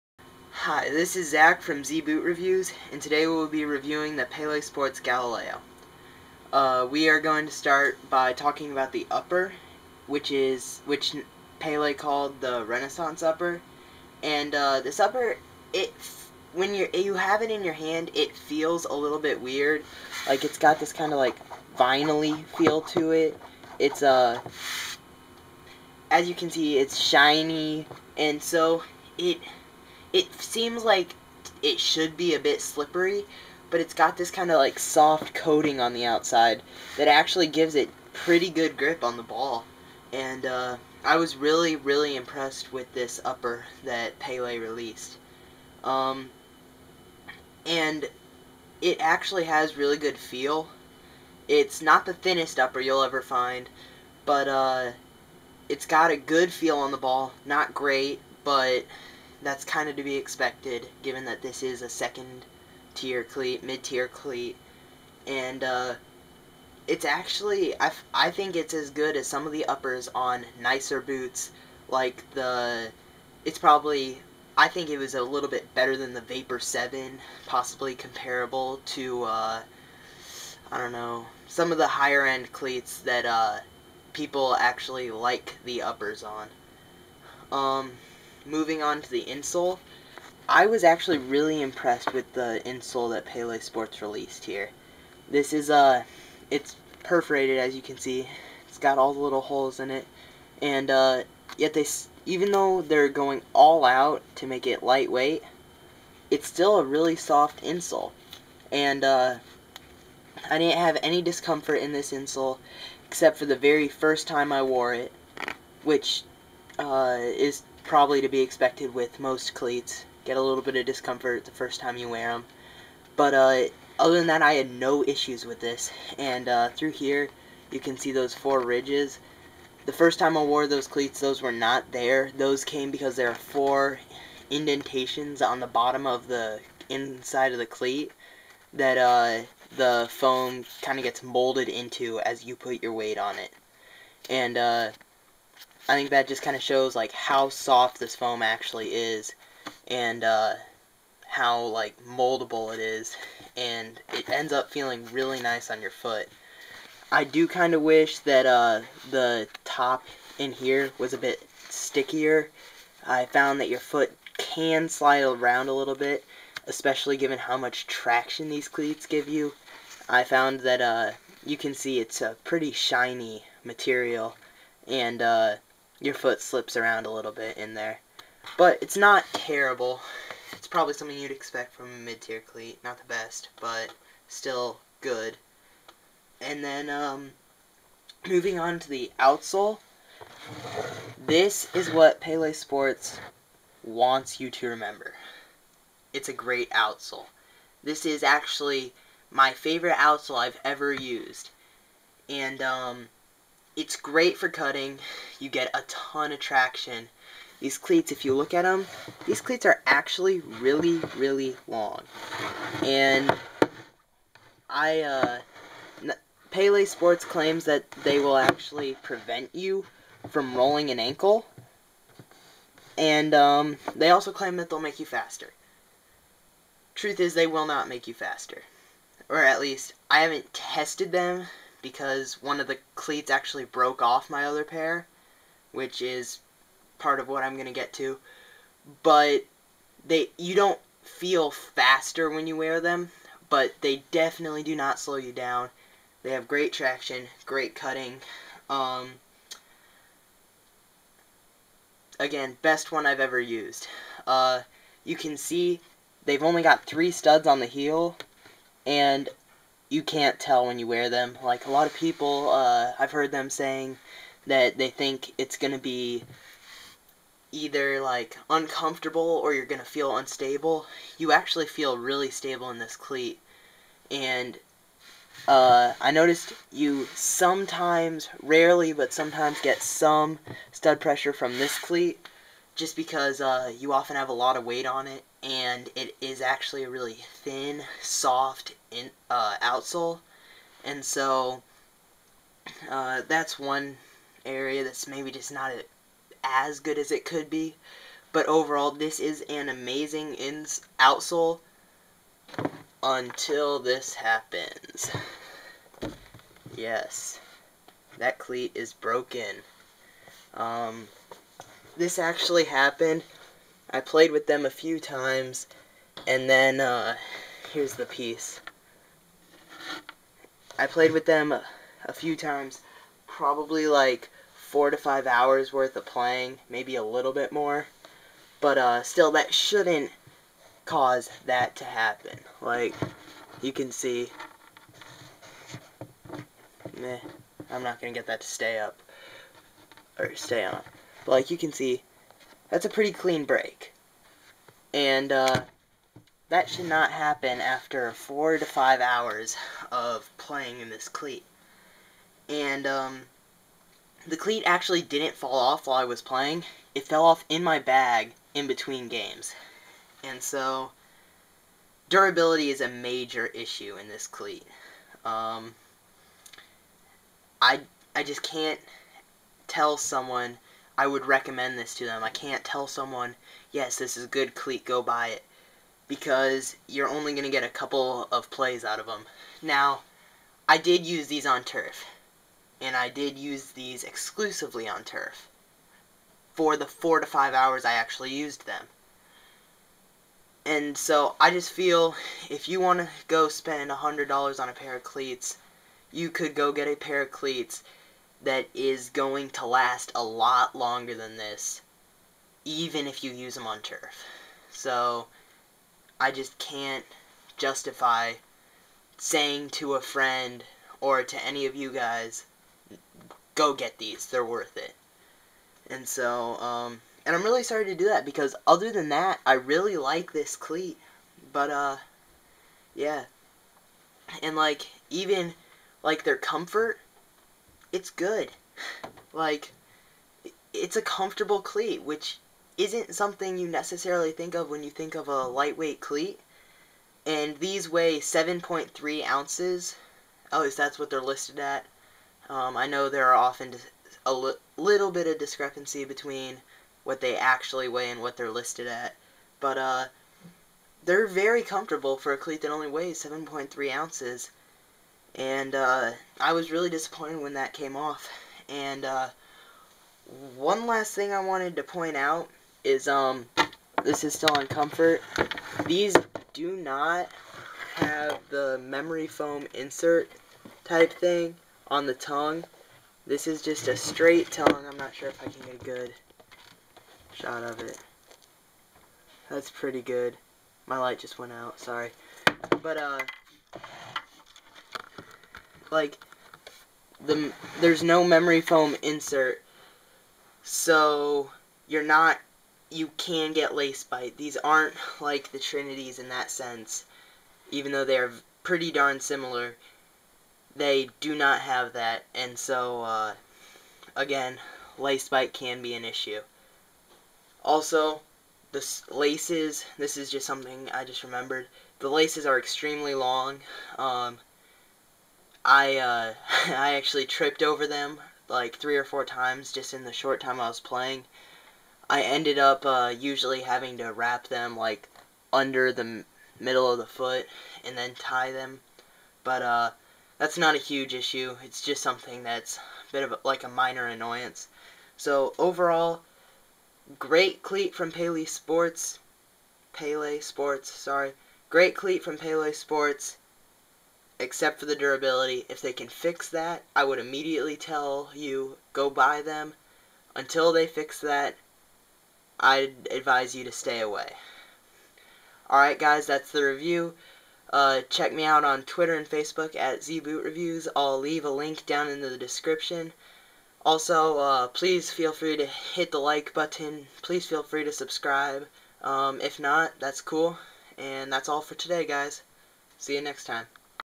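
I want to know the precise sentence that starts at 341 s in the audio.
But like, you can see, that's a pretty clean break.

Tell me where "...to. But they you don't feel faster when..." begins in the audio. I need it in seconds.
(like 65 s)
237 s.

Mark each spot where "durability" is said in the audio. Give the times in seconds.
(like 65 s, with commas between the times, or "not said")
362 s, 544 s.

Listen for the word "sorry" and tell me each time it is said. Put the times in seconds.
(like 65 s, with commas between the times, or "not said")
417 s, 481 s, 540 s.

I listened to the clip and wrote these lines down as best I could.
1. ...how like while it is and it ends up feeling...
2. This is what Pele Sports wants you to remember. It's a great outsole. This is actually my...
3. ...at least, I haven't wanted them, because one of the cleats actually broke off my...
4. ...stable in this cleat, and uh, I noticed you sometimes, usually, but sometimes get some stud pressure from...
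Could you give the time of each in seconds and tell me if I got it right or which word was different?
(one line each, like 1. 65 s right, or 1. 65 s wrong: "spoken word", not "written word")
1. 151 s wrong: "moldable", not "while"
2. 191 s right
3. 229 s wrong: "tested", not "wanted"
4. 272 s wrong: "rarely", not "usually".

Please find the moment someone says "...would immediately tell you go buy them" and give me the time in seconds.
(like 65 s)
547 s.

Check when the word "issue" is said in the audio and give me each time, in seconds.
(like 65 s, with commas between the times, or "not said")
125 s, 363 s, 506 s, 531 s.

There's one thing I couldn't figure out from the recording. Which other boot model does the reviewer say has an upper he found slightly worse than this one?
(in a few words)
Vapor 7.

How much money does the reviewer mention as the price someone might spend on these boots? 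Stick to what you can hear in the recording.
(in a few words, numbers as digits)
$100.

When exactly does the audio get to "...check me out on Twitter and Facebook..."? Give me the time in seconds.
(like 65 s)
558 s.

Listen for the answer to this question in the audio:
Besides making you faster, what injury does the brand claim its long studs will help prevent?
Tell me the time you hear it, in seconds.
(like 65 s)
220 s.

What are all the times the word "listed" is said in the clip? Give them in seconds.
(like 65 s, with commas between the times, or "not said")
441 s, 448 s.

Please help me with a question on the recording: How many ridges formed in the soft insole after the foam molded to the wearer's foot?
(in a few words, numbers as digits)
4.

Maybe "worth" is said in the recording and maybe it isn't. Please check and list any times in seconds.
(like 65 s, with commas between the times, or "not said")
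325 s, 414 s.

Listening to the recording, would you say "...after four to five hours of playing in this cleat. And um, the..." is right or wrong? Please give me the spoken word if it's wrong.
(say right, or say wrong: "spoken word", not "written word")
right.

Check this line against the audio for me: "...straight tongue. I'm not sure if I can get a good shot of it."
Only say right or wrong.
right.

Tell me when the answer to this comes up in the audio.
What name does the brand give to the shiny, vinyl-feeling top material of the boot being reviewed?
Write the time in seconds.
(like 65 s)
12 s.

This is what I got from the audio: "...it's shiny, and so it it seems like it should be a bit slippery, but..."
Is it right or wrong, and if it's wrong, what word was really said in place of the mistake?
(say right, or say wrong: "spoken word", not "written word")
right.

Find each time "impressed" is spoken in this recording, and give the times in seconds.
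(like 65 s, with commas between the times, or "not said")
42 s, 91 s.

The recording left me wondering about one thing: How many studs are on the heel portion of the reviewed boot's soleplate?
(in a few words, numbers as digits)
3.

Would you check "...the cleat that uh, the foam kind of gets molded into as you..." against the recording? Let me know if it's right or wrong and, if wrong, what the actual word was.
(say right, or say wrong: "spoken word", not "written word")
right.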